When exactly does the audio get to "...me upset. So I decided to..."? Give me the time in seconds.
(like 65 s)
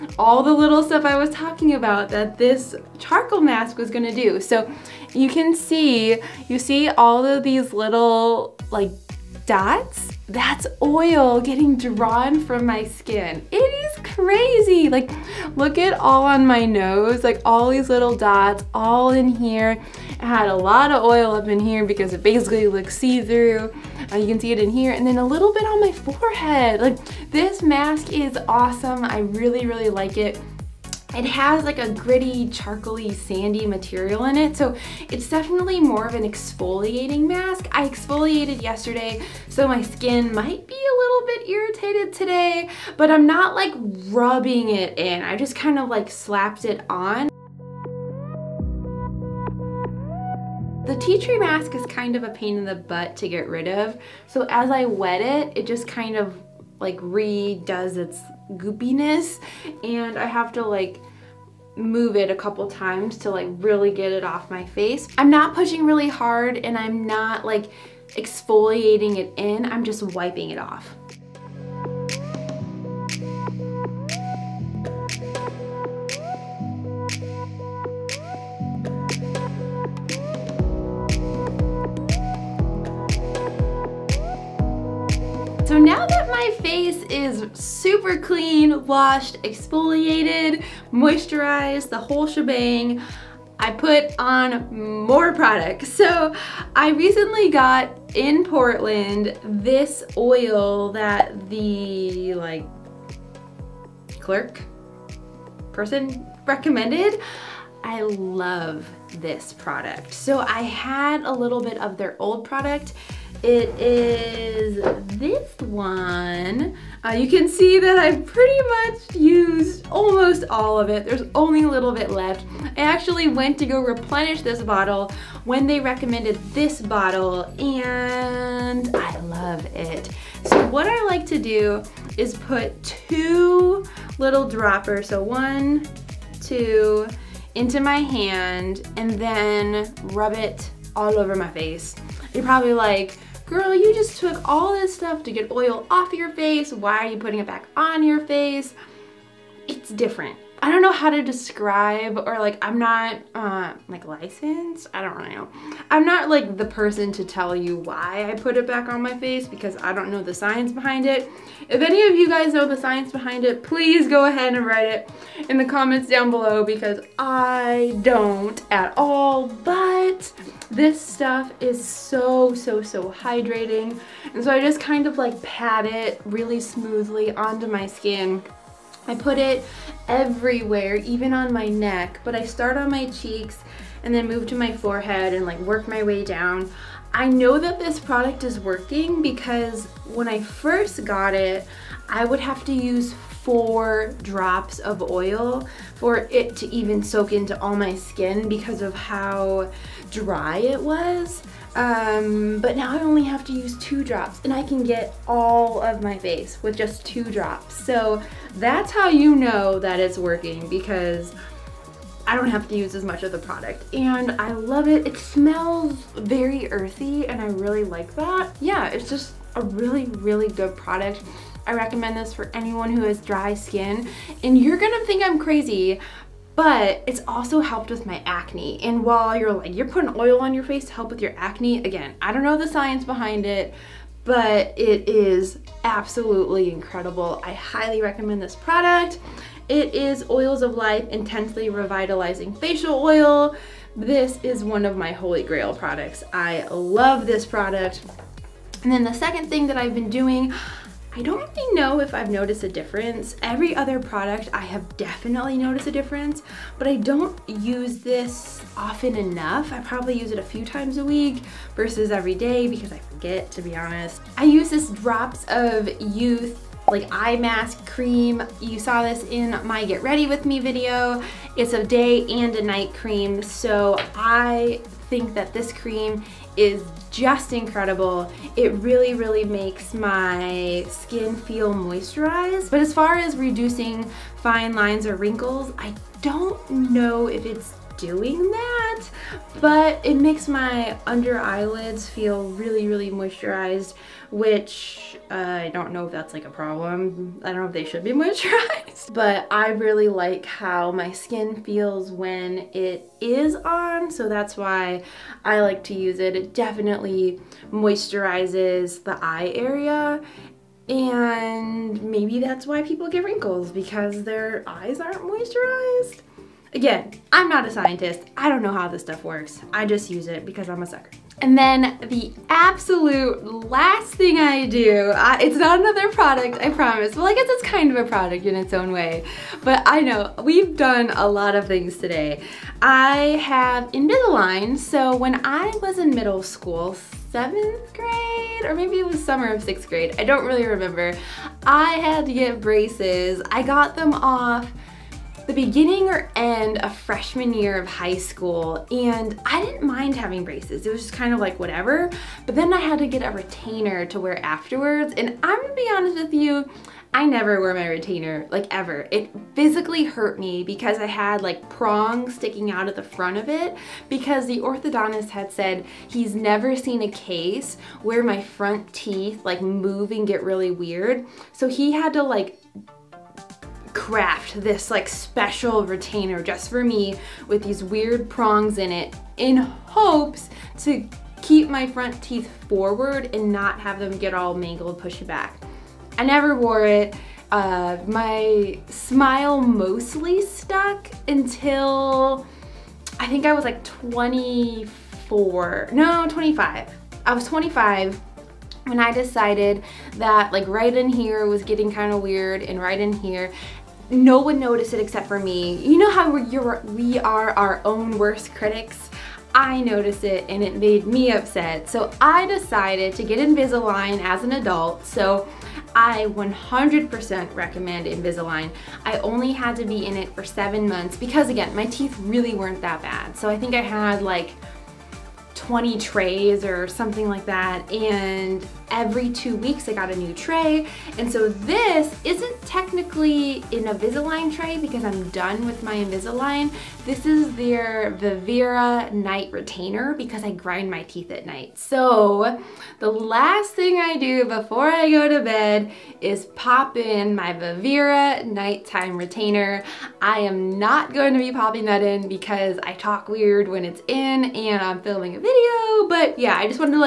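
411 s.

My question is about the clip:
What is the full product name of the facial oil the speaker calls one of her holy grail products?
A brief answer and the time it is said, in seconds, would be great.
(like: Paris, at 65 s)
Oils of Life Intensely Revitalizing Facial Oil, at 240 s.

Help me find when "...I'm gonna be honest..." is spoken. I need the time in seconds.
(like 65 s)
355 s.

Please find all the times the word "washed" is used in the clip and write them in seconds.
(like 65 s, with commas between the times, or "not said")
88 s.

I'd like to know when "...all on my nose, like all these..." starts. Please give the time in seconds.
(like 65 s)
15 s.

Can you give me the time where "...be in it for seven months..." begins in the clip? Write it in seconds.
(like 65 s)
419 s.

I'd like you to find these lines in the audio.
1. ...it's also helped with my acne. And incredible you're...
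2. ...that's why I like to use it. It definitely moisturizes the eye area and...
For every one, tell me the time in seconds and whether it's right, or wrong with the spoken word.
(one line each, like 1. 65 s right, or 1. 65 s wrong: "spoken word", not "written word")
1. 227 s wrong: "while", not "incredible"
2. 304 s right.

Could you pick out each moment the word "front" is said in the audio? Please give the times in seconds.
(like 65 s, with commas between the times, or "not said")
363 s, 368 s, 381 s.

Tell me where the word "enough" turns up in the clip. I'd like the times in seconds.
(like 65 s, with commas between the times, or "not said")
259 s.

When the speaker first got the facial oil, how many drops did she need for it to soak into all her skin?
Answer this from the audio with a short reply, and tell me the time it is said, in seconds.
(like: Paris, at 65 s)
4, at 193 s.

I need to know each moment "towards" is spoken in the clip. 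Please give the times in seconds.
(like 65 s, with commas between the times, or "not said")
not said.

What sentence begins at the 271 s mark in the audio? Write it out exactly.
It's a day and a night cream.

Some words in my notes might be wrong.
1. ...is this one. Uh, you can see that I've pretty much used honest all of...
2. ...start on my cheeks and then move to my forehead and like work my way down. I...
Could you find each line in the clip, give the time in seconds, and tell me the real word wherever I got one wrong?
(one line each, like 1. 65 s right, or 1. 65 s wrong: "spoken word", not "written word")
1. 113 s wrong: "almost", not "honest"
2. 182 s right.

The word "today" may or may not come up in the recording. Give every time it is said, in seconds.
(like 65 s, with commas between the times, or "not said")
42 s, 331 s.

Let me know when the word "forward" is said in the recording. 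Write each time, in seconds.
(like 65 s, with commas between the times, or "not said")
382 s.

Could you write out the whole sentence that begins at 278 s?
It really, really makes my skin feel moisturized.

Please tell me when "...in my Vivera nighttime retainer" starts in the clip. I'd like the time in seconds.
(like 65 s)
446 s.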